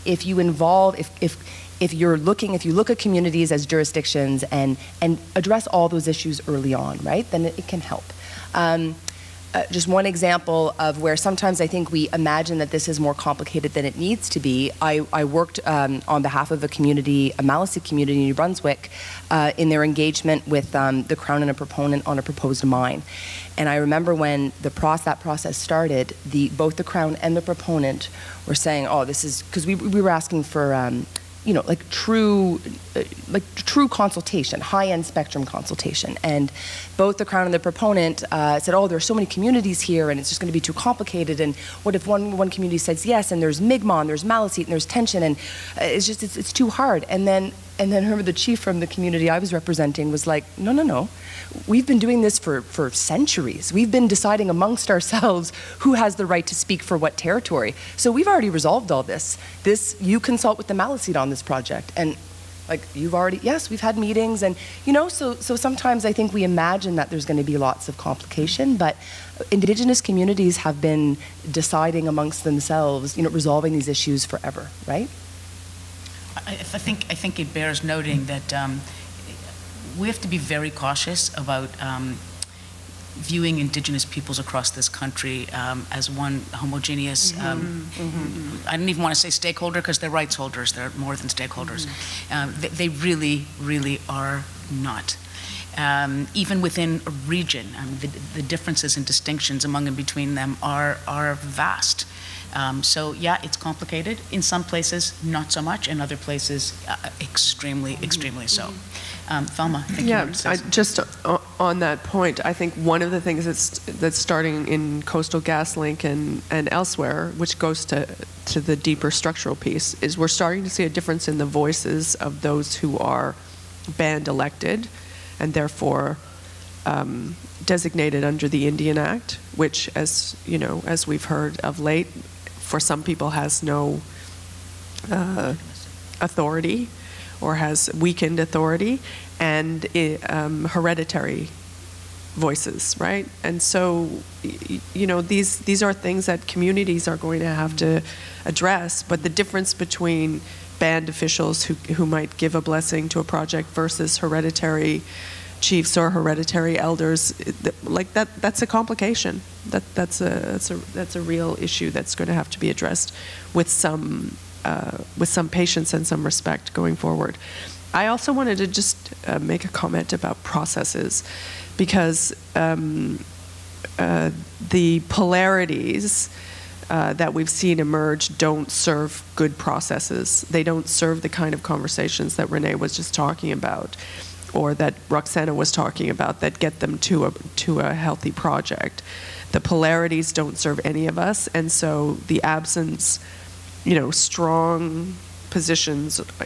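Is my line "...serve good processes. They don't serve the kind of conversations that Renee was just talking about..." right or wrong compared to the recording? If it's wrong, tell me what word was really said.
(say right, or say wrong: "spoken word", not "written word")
right.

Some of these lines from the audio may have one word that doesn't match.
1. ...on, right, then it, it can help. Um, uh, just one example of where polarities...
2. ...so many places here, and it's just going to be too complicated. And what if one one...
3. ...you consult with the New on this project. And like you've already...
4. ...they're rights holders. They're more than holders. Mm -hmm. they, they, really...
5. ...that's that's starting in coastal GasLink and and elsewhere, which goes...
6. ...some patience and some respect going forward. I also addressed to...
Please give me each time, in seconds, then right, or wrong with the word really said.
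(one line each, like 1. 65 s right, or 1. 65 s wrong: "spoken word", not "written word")
1. 6 s wrong: "sometimes", not "polarities"
2. 39 s wrong: "communities", not "places"
3. 59 s wrong: "Maliseet", not "New"
4. 89 s wrong: "stakeholders", not "holders"
5. 113 s right
6. 165 s wrong: "wanted", not "addressed".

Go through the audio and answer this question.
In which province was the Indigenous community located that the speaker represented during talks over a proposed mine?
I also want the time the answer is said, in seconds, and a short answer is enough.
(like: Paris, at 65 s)
New Brunswick, at 18 s.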